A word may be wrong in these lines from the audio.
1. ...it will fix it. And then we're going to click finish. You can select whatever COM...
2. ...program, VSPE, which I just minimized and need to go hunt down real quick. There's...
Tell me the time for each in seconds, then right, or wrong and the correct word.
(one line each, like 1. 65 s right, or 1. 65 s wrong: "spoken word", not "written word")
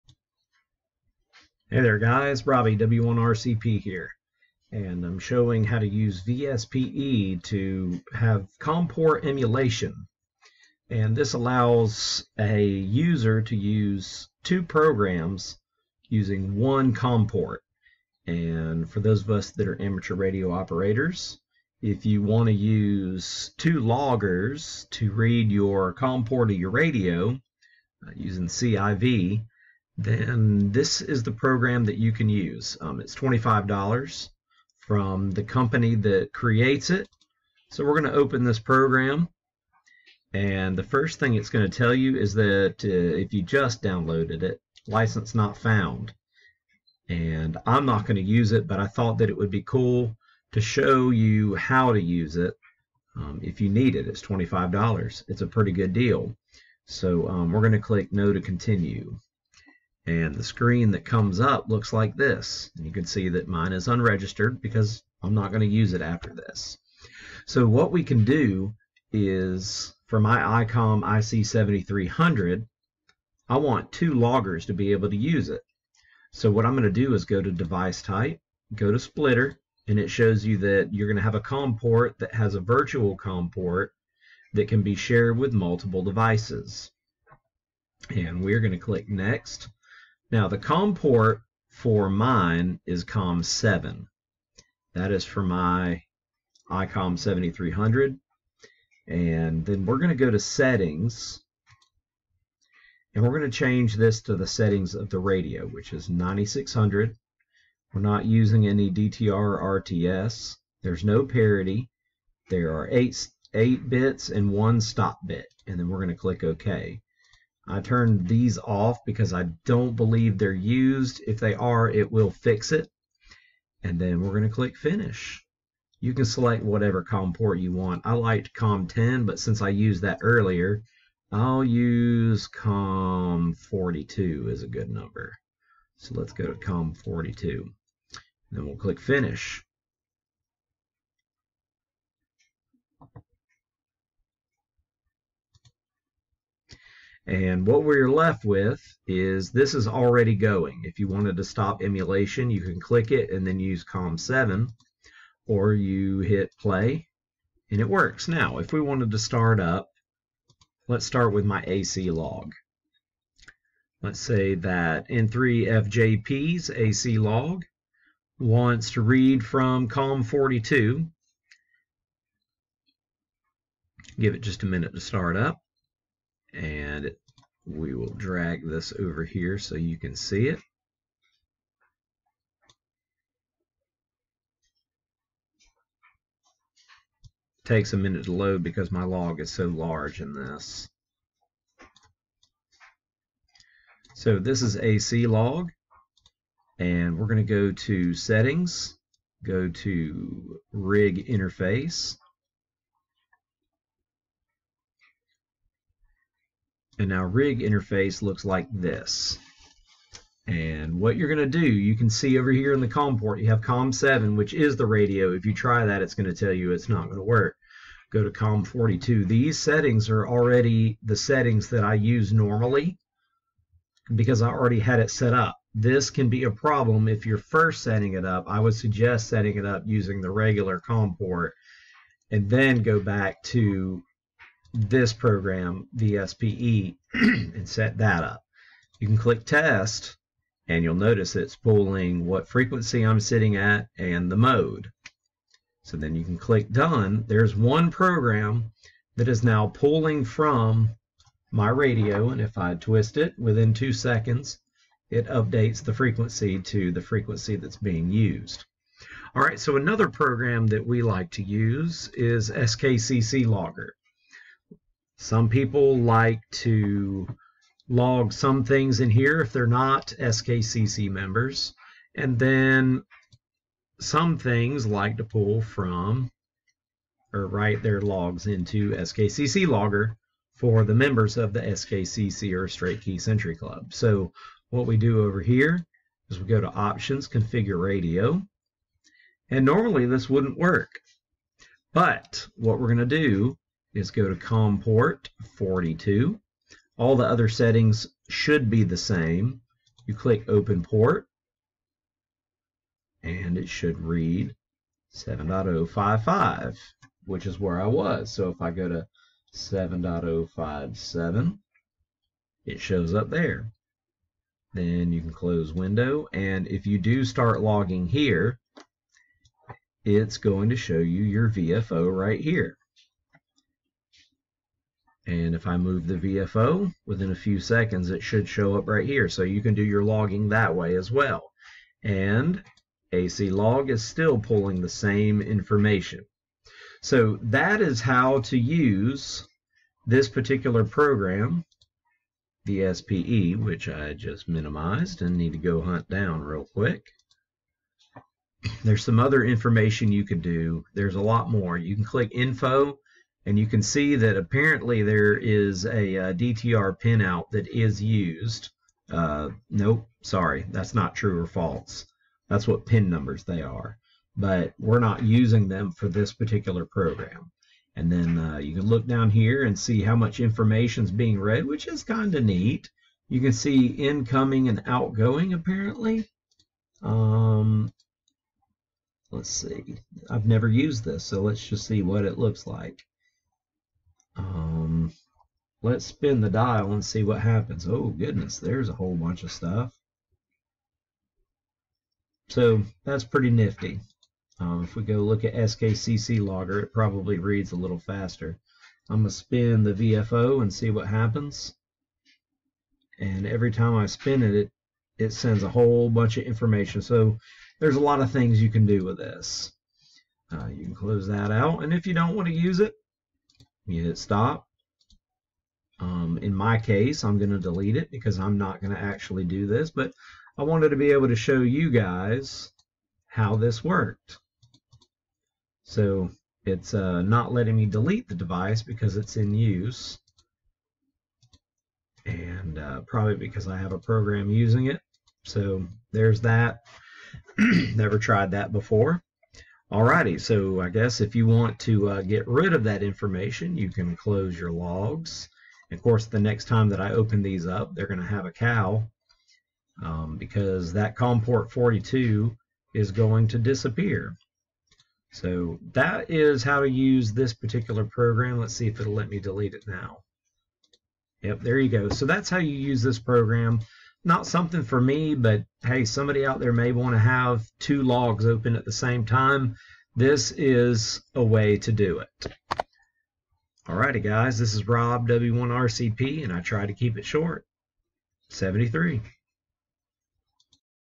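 1. 121 s right
2. 340 s right.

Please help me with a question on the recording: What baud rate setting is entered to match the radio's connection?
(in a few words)
9600.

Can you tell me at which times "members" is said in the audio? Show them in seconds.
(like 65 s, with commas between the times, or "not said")
271 s, 280 s.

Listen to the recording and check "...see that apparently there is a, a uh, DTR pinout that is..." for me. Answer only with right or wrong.
right.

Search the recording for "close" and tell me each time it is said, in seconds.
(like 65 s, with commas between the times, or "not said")
315 s, 410 s, 444 s.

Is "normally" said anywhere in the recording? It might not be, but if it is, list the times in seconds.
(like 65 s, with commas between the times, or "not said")
222 s, 289 s.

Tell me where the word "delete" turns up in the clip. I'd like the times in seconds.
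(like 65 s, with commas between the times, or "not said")
417 s, 427 s, 459 s.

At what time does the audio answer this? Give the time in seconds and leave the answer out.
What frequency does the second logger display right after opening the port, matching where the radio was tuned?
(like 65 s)
305 s.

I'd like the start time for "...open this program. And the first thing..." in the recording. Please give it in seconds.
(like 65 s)
38 s.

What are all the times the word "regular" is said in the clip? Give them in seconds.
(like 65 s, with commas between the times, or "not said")
230 s.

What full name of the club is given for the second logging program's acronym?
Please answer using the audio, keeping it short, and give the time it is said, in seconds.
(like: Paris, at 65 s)
Straight Key Century Club, at 282 s.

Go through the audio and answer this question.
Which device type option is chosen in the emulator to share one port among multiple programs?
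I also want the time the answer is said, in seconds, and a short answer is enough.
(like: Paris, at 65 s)
splitter, at 78 s.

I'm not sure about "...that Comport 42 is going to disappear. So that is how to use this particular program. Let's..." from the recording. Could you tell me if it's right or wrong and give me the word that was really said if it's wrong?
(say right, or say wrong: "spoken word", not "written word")
right.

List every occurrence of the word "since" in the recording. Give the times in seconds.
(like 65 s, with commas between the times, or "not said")
129 s.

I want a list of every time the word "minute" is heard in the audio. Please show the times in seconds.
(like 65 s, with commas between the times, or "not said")
174 s, 187 s.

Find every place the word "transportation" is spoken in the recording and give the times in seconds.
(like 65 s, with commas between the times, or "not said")
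not said.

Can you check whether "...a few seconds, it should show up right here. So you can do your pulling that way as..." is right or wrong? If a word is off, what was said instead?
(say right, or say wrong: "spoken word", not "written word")
wrong: "logging", not "pulling".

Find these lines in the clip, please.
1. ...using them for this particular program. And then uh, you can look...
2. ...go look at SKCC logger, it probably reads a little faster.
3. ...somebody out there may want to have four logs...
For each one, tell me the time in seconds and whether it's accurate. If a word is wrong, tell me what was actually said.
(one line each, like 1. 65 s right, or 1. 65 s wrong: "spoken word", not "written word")
1. 365 s right
2. 395 s right
3. 466 s wrong: "two", not "four".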